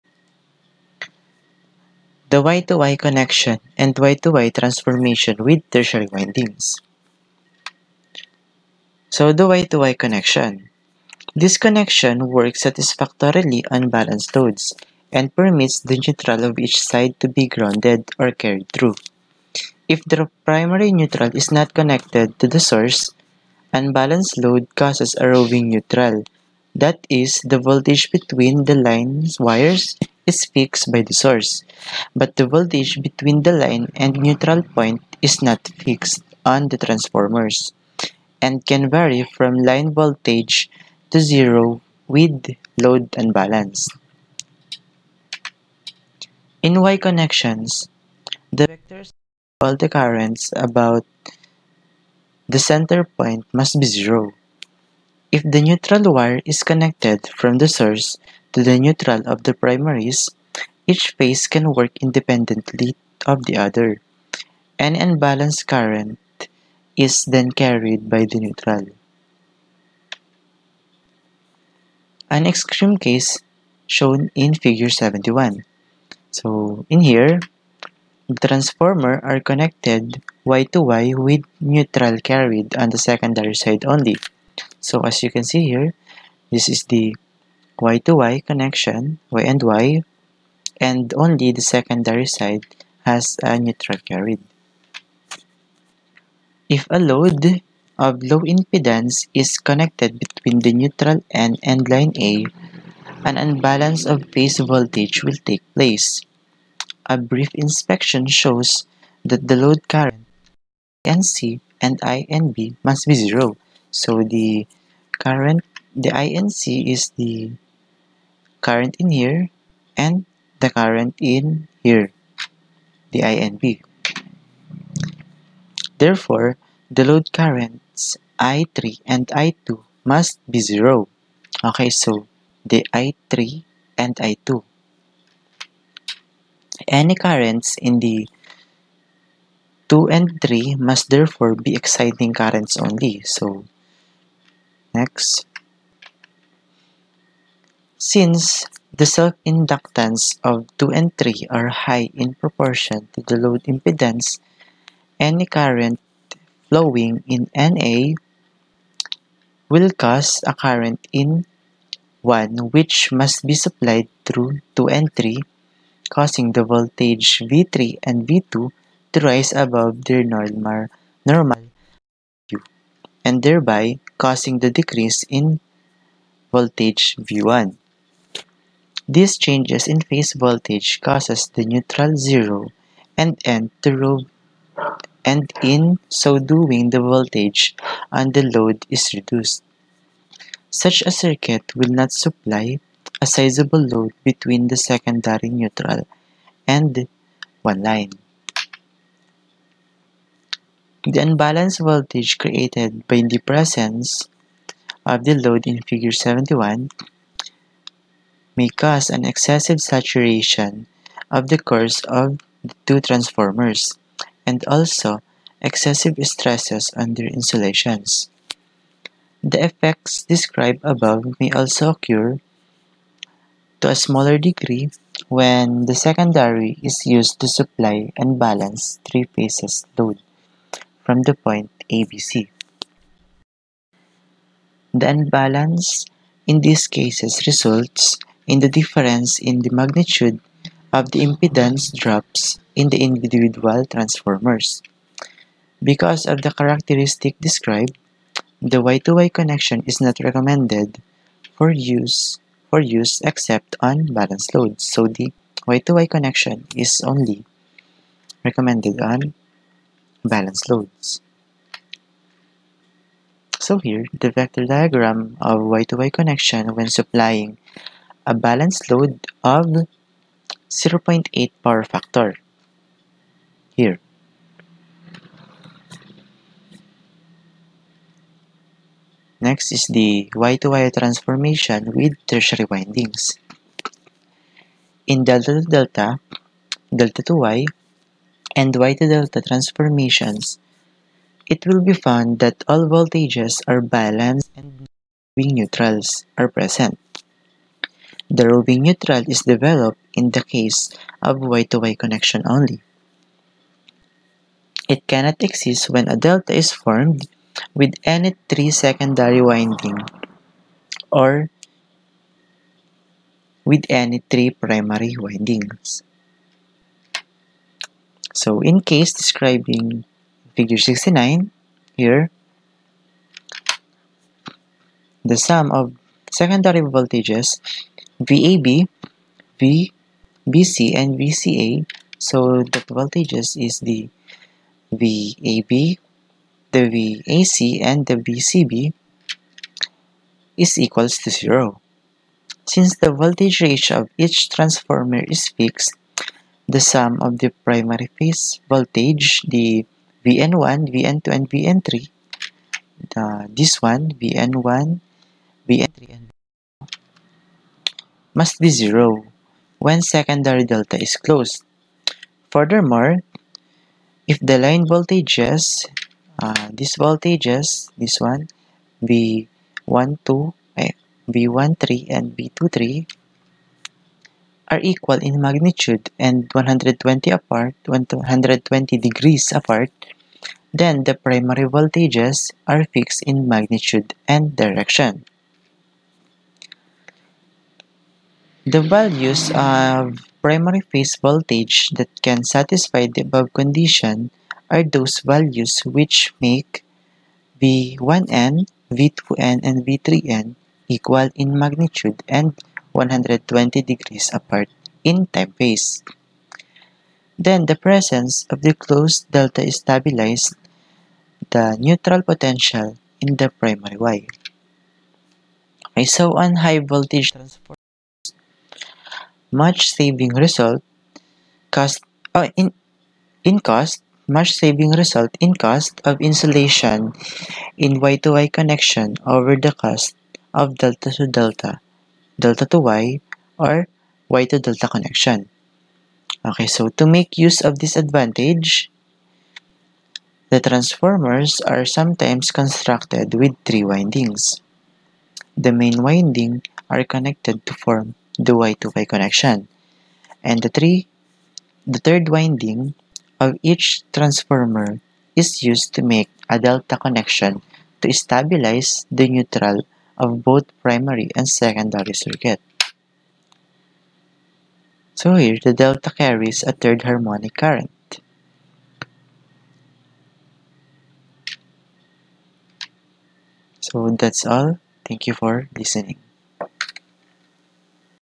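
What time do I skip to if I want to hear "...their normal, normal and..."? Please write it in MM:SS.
02:50.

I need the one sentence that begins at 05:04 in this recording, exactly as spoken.
It cannot exist when a delta is formed with any three secondary winding or with any three primary windings.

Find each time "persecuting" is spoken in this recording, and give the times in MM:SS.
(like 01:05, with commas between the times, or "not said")
not said.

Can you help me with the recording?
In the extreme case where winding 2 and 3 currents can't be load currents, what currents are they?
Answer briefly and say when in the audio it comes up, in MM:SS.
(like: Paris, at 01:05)
exciting currents, at 02:21.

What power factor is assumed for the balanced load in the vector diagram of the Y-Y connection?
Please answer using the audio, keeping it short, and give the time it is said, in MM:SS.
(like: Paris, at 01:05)
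0.8, at 04:30.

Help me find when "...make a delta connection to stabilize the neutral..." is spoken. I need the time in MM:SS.
07:36.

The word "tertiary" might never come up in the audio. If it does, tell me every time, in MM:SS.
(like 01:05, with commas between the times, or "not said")
00:05, 04:42.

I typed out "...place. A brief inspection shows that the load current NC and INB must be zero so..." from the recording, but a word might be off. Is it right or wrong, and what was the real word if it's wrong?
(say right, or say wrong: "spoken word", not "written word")
right.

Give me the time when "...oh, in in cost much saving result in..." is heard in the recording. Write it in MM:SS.
07:02.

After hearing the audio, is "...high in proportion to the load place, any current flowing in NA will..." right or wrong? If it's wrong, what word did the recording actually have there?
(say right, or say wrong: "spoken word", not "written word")
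wrong: "impedance", not "place".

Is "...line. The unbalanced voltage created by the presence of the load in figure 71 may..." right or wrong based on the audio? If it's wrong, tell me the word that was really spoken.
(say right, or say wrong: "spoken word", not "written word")
right.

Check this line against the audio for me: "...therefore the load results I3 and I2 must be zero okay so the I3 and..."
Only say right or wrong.
wrong.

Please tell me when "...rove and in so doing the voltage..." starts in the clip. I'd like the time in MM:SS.
03:03.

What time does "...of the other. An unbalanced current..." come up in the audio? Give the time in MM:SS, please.
01:03.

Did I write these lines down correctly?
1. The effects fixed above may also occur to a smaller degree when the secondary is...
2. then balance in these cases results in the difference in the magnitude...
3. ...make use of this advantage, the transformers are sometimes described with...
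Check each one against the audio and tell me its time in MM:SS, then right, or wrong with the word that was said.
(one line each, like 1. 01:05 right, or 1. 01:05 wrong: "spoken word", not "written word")
1. 03:39 wrong: "described", not "fixed"
2. 03:54 right
3. 07:17 wrong: "constructed", not "described".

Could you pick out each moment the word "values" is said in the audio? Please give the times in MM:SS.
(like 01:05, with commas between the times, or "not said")
06:28, 06:35.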